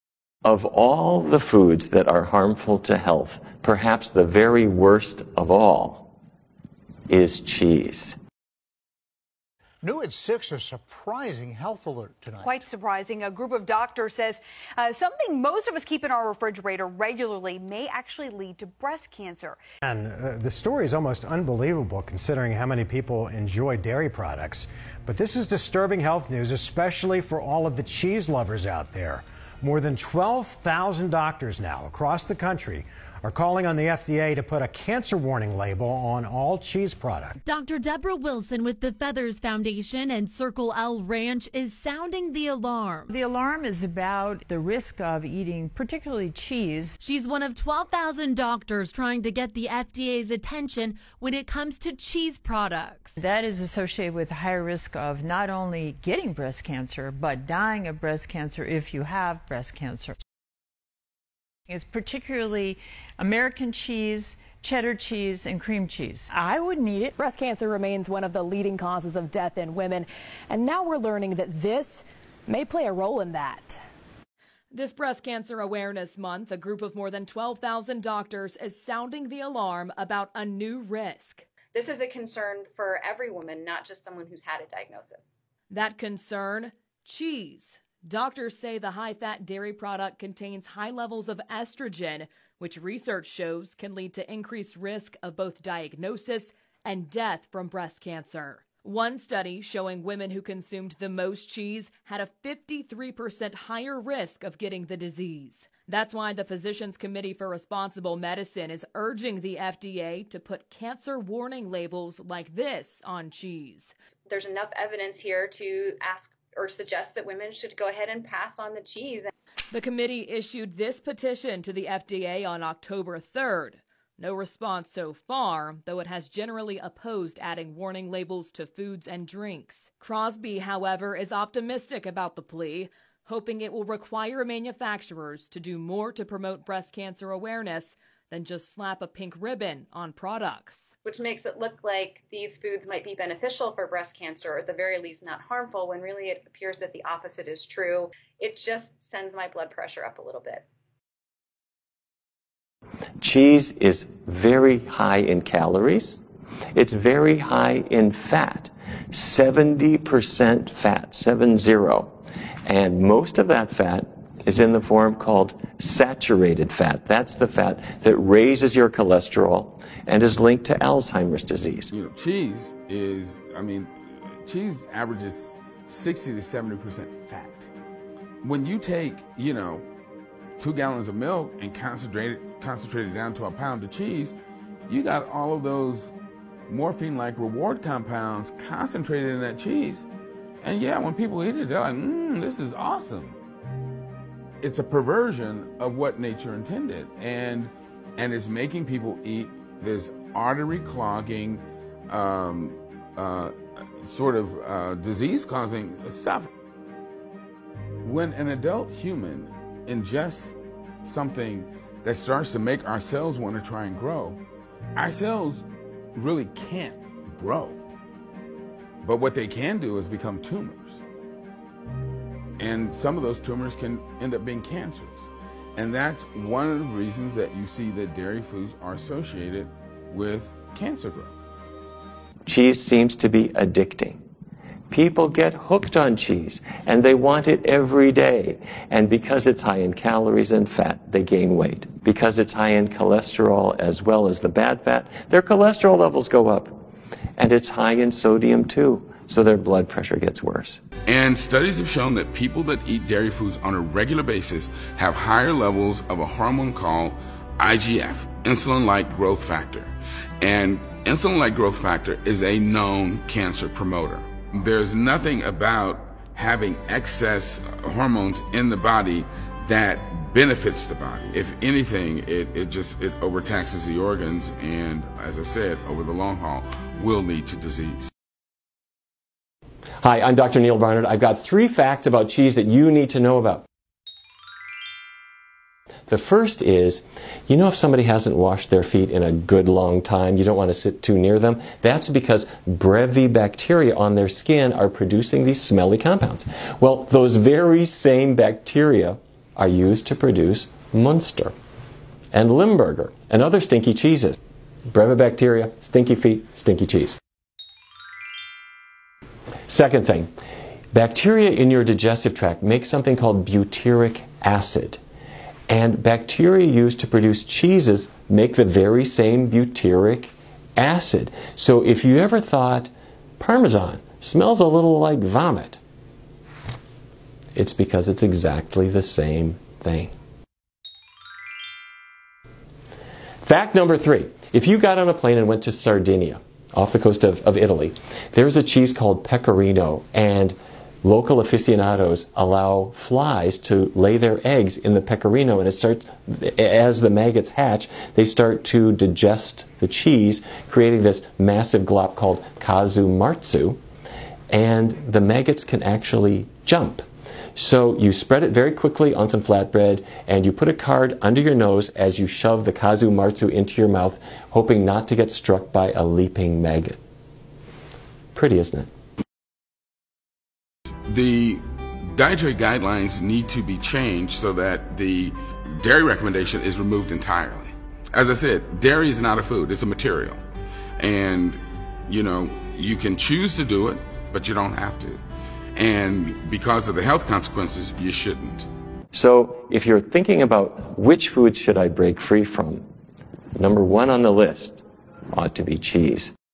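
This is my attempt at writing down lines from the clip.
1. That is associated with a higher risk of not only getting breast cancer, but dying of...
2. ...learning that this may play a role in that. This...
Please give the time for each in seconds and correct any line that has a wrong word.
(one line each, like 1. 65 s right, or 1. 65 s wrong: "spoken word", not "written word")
1. 53 s right
2. 70 s right.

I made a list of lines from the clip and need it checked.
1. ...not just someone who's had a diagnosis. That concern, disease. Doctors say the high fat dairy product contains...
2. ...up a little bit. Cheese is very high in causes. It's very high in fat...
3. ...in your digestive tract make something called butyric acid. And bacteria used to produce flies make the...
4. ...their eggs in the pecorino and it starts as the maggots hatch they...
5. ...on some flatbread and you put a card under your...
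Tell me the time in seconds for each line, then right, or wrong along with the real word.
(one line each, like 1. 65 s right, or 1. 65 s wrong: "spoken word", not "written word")
1. 83 s wrong: "cheese", not "disease"
2. 150 s wrong: "calories", not "causes"
3. 311 s wrong: "cheeses", not "flies"
4. 344 s right
5. 359 s right.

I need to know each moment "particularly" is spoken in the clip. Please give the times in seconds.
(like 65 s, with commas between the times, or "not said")
45 s, 61 s.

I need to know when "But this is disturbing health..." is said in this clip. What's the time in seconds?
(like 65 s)
25 s.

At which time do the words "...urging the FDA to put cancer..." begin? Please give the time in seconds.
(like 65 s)
108 s.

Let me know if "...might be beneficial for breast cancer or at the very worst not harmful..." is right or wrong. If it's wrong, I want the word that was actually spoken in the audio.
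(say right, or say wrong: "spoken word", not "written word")
wrong: "least", not "worst".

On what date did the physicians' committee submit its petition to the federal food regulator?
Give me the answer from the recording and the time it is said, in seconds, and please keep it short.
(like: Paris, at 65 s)
October 3rd, at 122 s.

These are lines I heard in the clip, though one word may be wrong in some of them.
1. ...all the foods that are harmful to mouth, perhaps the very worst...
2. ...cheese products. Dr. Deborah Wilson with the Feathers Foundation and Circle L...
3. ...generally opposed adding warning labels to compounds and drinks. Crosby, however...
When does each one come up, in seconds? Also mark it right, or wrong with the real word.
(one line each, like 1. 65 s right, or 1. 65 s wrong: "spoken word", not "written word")
1. 0 s wrong: "health", not "mouth"
2. 36 s right
3. 126 s wrong: "foods", not "compounds".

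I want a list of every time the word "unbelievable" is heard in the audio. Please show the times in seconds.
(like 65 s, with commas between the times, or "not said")
21 s.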